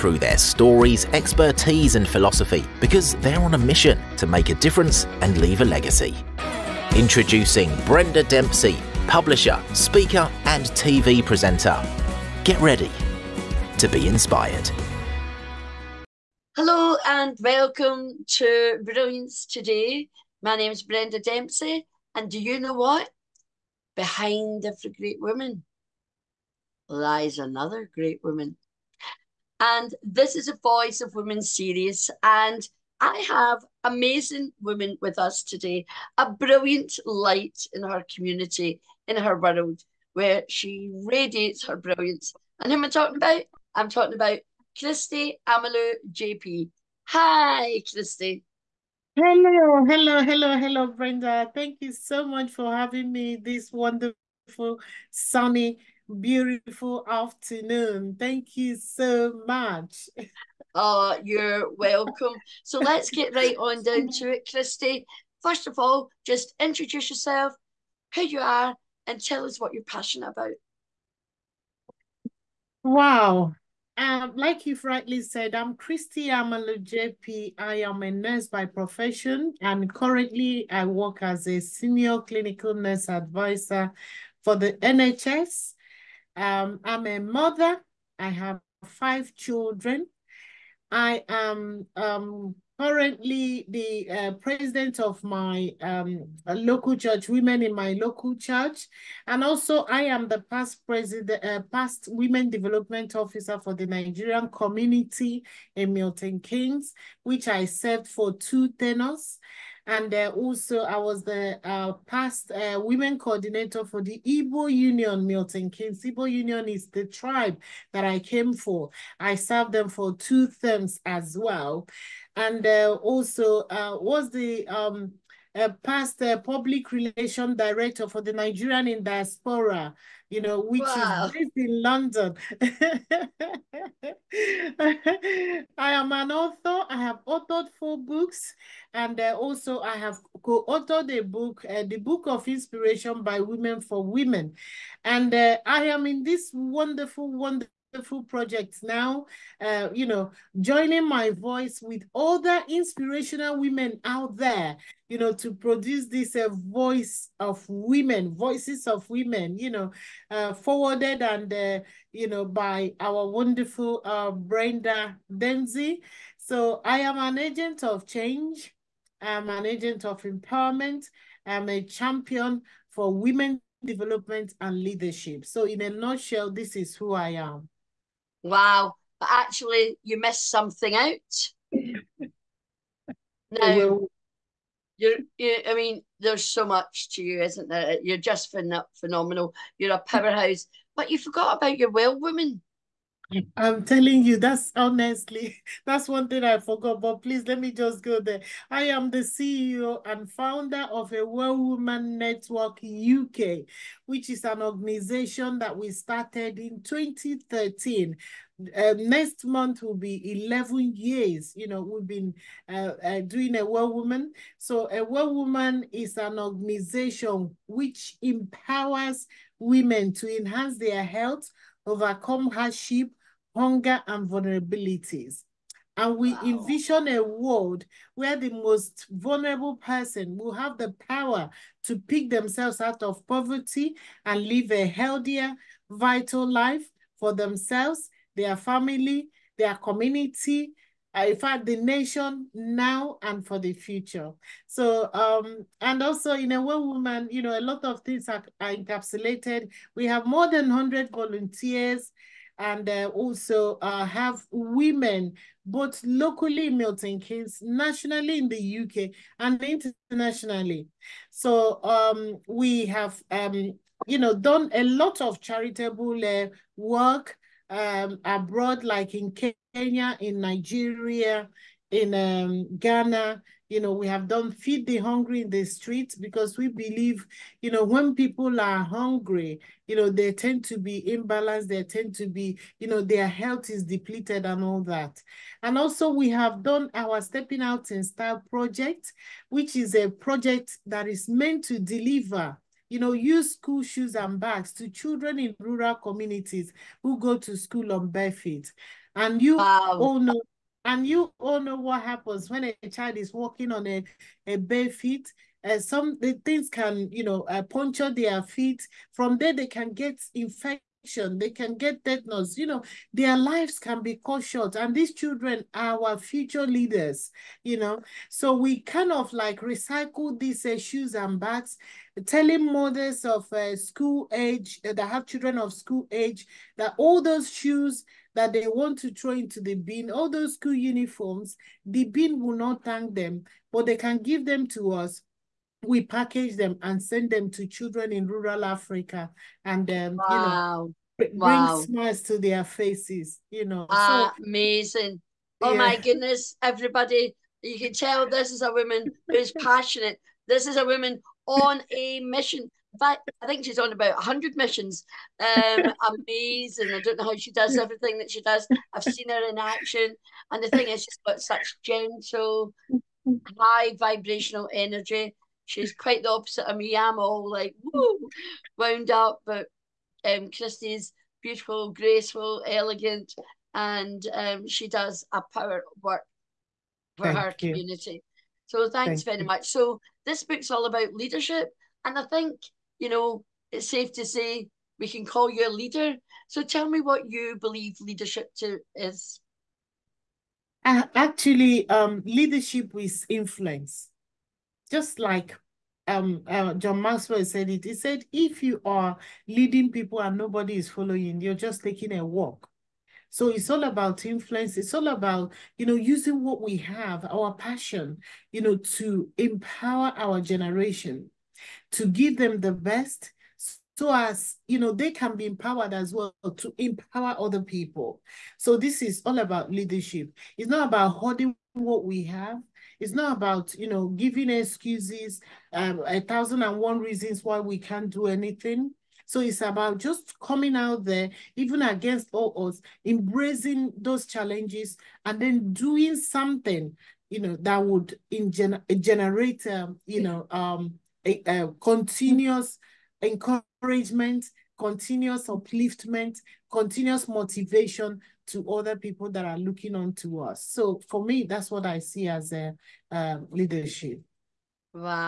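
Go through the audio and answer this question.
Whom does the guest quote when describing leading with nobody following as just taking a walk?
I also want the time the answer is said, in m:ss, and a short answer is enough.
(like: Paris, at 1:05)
John Maxwell, at 6:36.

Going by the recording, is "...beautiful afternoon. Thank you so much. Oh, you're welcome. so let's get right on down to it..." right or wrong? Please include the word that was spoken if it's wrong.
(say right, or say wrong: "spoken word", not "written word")
right.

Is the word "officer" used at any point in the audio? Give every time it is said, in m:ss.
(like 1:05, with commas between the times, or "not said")
1:43.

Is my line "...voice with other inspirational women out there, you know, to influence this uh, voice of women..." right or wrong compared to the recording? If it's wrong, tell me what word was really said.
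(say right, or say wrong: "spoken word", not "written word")
wrong: "produce", not "influence".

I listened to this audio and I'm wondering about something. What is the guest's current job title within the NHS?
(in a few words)
Senior clinical nurse advisor.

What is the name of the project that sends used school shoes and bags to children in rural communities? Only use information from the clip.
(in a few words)
Stepping Out in Style.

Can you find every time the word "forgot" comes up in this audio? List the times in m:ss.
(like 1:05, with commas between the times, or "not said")
3:11, 3:16.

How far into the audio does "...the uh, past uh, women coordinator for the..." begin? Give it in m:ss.
1:51.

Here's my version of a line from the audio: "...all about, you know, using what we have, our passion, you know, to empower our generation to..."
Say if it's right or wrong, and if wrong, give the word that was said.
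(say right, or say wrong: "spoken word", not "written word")
right.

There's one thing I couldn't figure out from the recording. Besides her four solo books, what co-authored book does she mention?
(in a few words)
The Book of Inspiration by Women for Women.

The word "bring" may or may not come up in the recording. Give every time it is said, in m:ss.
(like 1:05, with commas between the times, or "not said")
5:41.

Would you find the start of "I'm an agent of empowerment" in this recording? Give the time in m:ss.
2:49.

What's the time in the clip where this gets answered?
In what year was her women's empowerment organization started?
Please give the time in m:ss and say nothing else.
3:26.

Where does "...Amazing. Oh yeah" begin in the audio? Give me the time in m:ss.
5:44.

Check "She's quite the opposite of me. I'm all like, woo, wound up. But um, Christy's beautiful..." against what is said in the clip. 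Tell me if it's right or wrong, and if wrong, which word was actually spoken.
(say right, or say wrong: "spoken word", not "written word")
right.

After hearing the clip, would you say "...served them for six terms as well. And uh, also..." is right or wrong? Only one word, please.
wrong.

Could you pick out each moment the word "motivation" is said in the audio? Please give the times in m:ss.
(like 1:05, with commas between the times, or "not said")
7:27.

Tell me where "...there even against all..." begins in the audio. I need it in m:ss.
7:11.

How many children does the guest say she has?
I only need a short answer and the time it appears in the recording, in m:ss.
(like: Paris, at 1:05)
5, at 1:28.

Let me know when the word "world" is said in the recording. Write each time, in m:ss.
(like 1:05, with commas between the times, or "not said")
0:39, 3:47.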